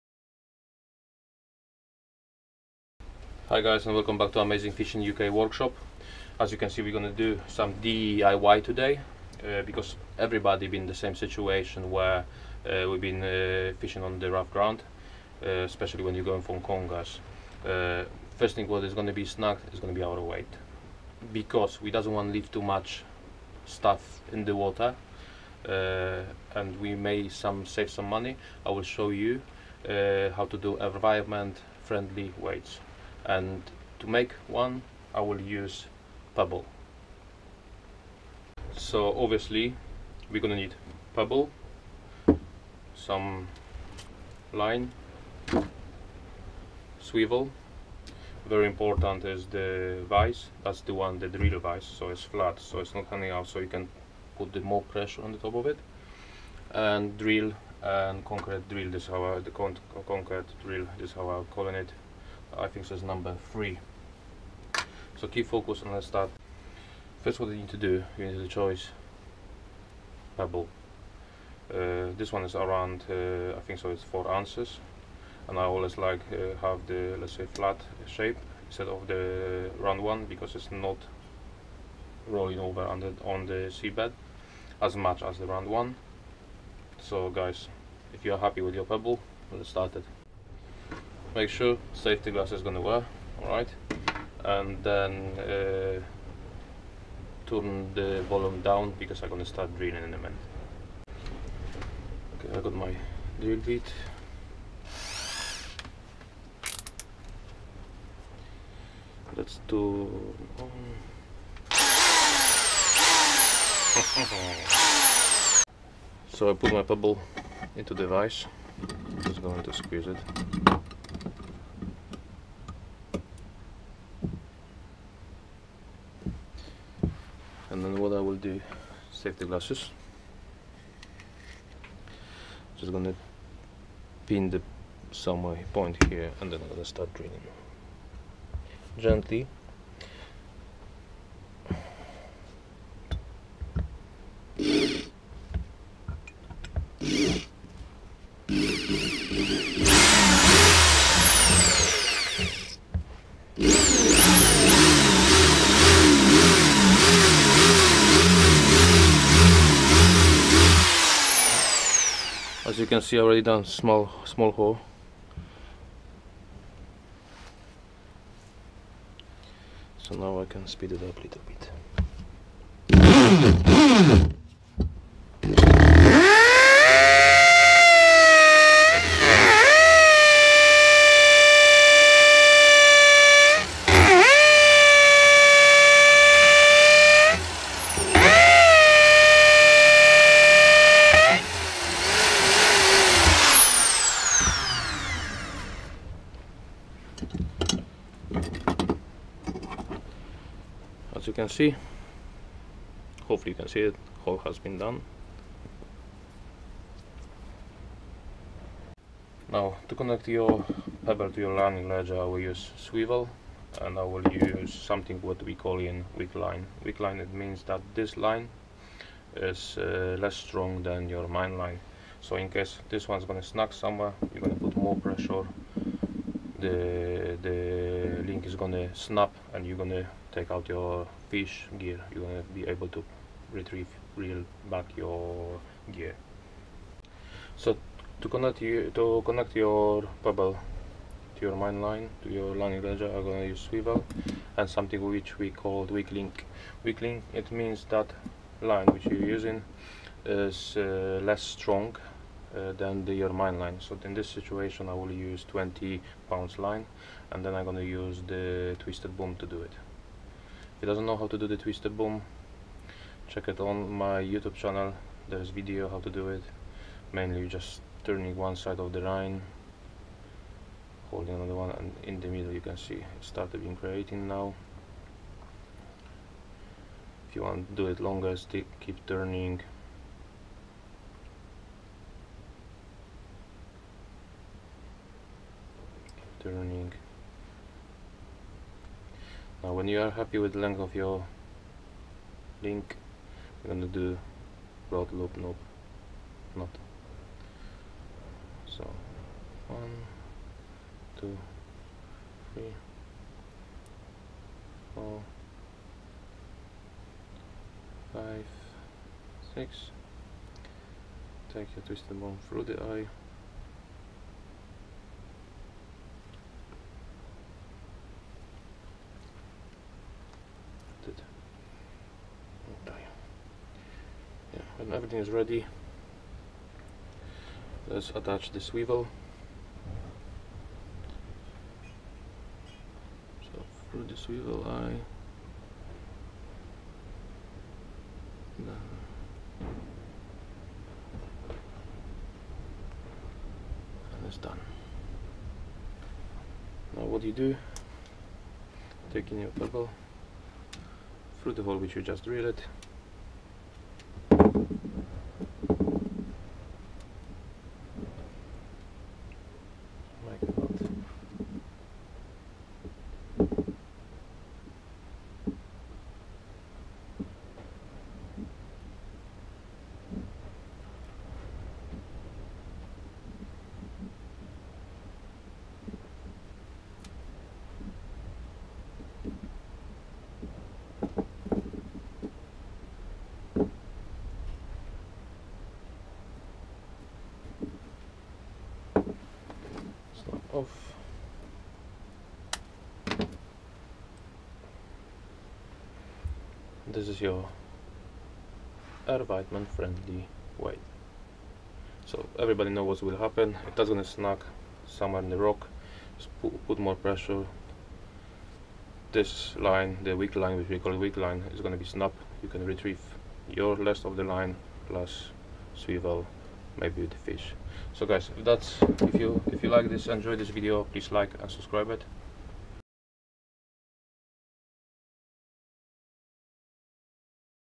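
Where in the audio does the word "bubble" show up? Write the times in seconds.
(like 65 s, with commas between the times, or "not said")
240 s, 349 s.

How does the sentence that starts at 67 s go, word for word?
First what you need to do, you need to choose pebble.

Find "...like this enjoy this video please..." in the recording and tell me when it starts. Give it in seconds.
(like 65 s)
419 s.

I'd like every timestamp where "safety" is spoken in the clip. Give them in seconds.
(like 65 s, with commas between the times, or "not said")
91 s, 129 s.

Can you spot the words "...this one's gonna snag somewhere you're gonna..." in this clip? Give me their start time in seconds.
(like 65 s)
222 s.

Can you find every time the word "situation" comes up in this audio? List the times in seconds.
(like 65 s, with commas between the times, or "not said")
11 s, 254 s.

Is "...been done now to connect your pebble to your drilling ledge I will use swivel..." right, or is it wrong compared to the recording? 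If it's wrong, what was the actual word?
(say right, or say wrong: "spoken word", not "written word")
wrong: "landing", not "drilling".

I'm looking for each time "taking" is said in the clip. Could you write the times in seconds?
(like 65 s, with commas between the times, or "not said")
349 s.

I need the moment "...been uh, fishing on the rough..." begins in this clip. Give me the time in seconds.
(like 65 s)
13 s.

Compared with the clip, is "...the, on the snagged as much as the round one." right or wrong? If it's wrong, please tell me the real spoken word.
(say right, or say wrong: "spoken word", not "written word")
wrong: "seabed", not "snagged".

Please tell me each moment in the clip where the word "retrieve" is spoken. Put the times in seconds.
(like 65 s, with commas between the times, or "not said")
233 s, 412 s.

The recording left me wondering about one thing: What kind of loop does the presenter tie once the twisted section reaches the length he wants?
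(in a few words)
Blood loop.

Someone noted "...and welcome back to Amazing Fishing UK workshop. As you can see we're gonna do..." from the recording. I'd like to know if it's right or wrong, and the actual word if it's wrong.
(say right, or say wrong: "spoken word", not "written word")
right.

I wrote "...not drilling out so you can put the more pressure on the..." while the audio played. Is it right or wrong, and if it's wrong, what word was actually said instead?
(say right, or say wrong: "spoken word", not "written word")
wrong: "hanging", not "drilling".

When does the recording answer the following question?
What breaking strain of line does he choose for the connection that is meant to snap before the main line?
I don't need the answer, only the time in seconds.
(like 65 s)
255 s.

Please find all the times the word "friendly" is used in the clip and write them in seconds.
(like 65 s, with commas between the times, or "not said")
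31 s, 399 s.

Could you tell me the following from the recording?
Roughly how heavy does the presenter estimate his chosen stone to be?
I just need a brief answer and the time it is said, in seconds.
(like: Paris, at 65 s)
4 ounces, at 74 s.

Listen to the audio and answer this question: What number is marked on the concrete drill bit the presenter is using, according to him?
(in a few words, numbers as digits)
3.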